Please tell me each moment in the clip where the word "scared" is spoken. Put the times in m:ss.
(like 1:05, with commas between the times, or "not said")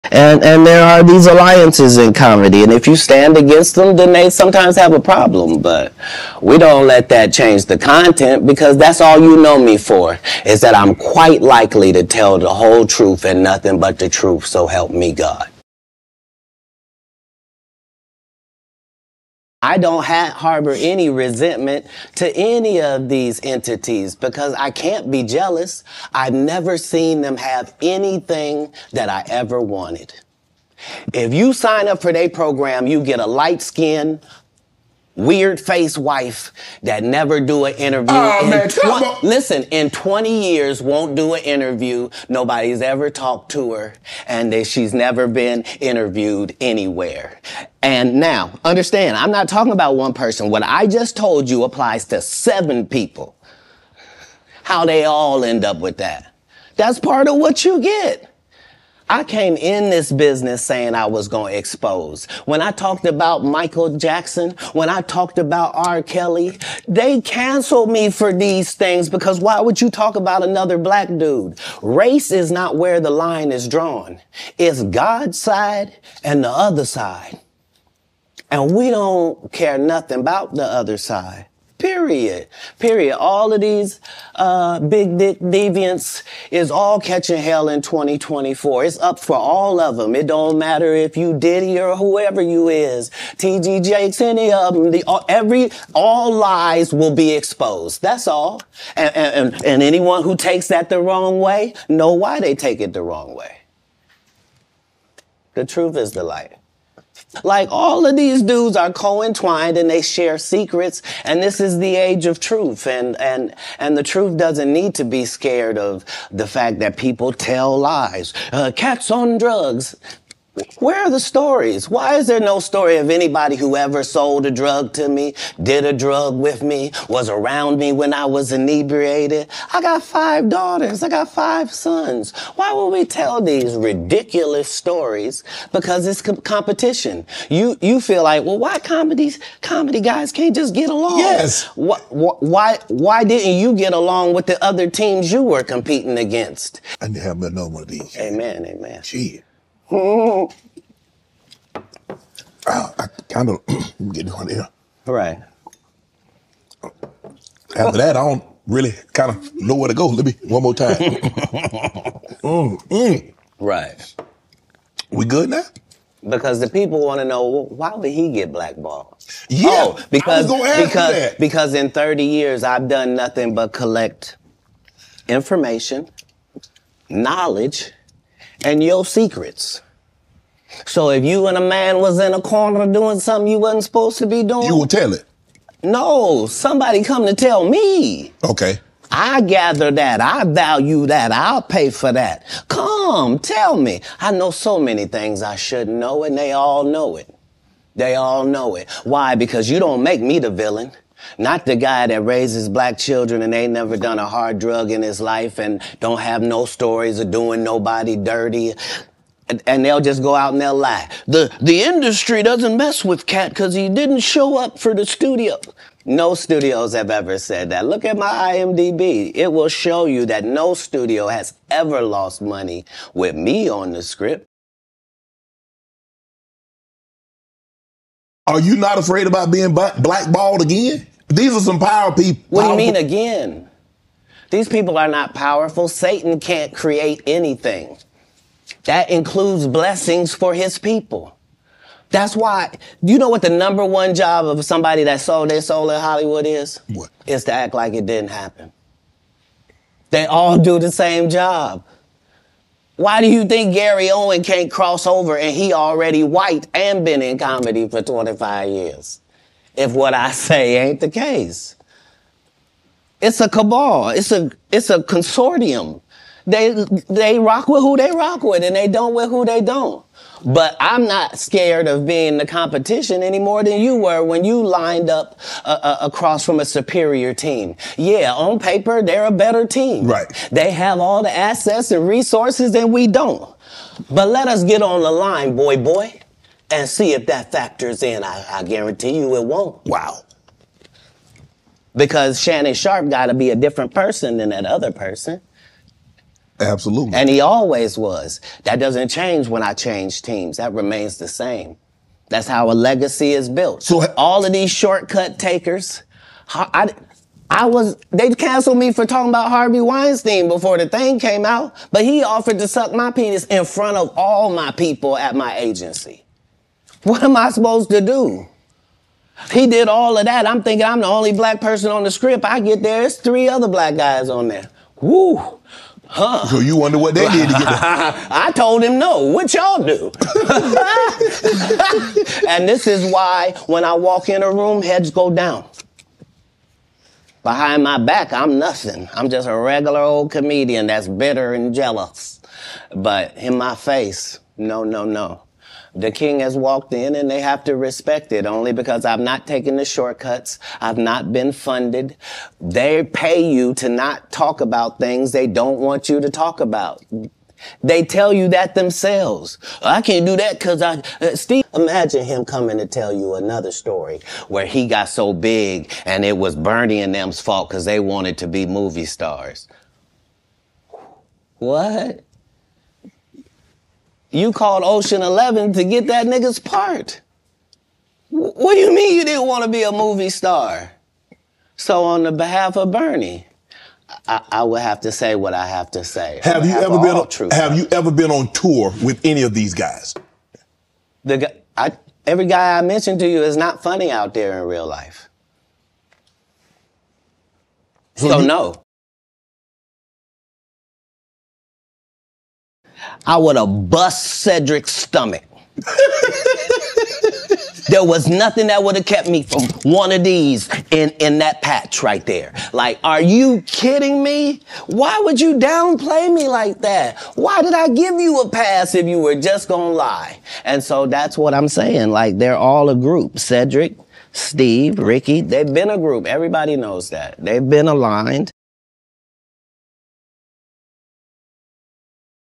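1:55, 4:31.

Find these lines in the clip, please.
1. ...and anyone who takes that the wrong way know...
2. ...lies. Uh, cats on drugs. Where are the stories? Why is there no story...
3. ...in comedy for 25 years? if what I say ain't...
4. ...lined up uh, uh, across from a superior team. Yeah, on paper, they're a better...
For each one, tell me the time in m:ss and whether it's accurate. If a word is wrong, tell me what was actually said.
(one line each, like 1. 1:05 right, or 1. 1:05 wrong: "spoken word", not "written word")
1. 1:39 right
2. 1:57 right
3. 4:17 right
4. 4:34 right.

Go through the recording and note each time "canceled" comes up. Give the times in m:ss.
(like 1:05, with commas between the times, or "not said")
1:07, 5:08.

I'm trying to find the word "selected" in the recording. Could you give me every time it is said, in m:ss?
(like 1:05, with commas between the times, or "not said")
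not said.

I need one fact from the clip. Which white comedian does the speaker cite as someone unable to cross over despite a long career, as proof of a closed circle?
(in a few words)
Gary Owen.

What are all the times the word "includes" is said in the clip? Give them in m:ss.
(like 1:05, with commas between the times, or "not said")
3:59.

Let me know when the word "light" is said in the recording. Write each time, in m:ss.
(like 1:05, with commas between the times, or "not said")
0:33, 1:46.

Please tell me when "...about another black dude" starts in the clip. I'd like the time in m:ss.
1:10.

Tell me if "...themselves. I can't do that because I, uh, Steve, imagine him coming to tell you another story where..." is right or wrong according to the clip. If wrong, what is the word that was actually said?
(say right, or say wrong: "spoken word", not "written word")
right.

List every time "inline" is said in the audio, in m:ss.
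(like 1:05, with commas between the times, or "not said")
not said.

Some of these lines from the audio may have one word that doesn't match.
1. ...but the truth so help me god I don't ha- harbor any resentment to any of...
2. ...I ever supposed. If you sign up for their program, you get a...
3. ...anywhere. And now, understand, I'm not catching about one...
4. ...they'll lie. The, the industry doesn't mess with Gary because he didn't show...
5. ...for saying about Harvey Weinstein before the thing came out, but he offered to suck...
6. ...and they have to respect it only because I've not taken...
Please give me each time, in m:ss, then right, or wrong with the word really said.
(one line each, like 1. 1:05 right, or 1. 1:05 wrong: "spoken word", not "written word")
1. 0:13 right
2. 0:29 wrong: "wanted", not "supposed"
3. 0:46 wrong: "talking", not "catching"
4. 3:30 wrong: "Katt", not "Gary"
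5. 5:08 wrong: "talking", not "saying"
6. 5:47 right.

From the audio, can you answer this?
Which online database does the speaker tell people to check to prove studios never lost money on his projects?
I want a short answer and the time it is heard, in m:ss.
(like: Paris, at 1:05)
IMDb, at 3:38.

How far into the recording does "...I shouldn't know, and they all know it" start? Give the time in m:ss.
3:15.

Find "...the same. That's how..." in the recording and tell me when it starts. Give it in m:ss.
5:01.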